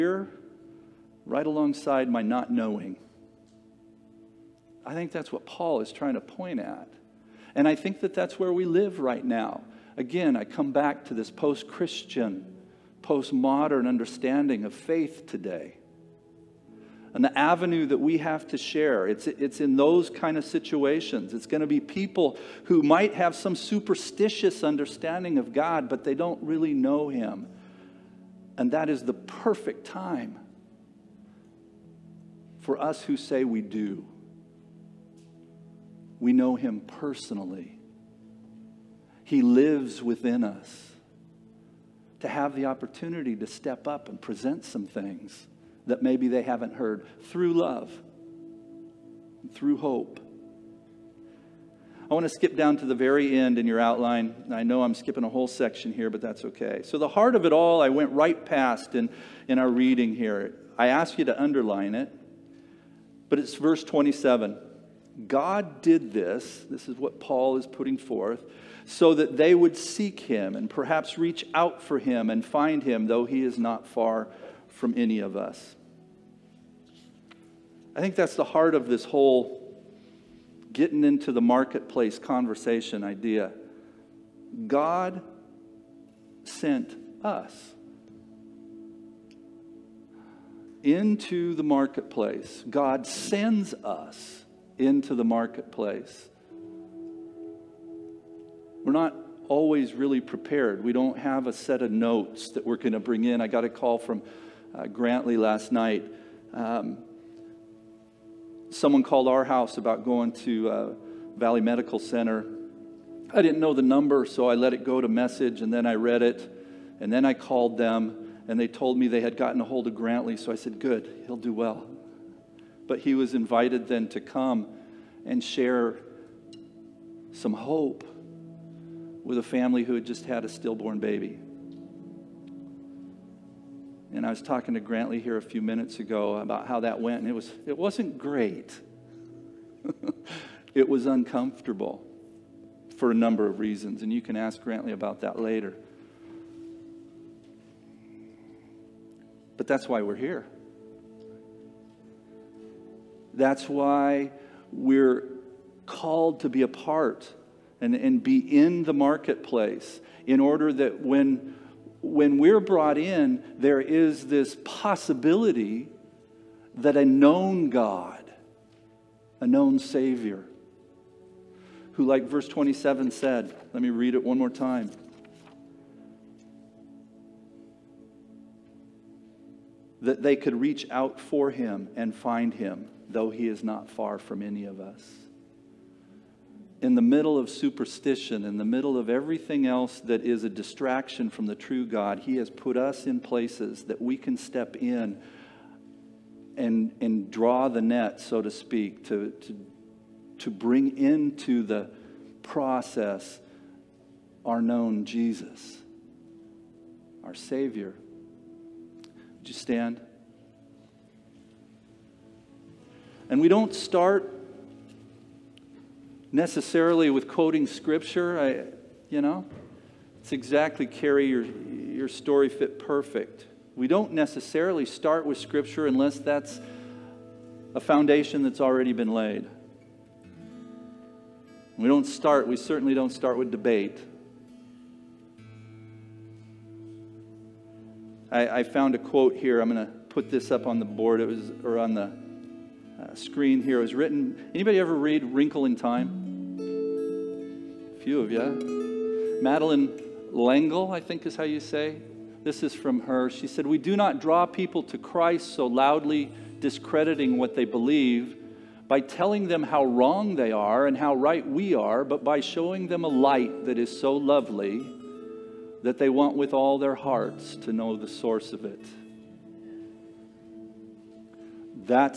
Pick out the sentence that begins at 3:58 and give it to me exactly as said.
I, I found a quote here.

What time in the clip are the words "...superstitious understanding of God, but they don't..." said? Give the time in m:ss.
0:23.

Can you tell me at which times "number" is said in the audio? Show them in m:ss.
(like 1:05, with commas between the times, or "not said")
1:53, 2:23.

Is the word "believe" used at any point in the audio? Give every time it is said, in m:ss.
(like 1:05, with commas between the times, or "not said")
4:17.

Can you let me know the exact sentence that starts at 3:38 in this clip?
I, you know, it's exactly Carrie your, your story fit perfect.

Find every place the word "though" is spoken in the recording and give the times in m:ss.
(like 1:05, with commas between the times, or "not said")
1:13, 3:03.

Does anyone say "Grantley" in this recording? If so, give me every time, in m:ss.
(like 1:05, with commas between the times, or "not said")
1:44, 1:59, 2:14, 2:24.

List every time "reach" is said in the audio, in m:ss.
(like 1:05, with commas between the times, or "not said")
1:11, 3:00.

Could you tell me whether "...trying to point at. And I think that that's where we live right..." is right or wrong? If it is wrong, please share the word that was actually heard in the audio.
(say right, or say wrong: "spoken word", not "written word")
right.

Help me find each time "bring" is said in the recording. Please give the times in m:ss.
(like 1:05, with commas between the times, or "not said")
1:42, 3:20.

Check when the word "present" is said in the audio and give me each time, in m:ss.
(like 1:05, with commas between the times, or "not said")
0:44.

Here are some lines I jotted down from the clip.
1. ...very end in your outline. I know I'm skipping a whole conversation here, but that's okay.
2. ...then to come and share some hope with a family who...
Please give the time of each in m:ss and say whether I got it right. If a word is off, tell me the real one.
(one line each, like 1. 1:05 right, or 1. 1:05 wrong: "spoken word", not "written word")
1. 0:52 wrong: "section", not "conversation"
2. 2:03 right.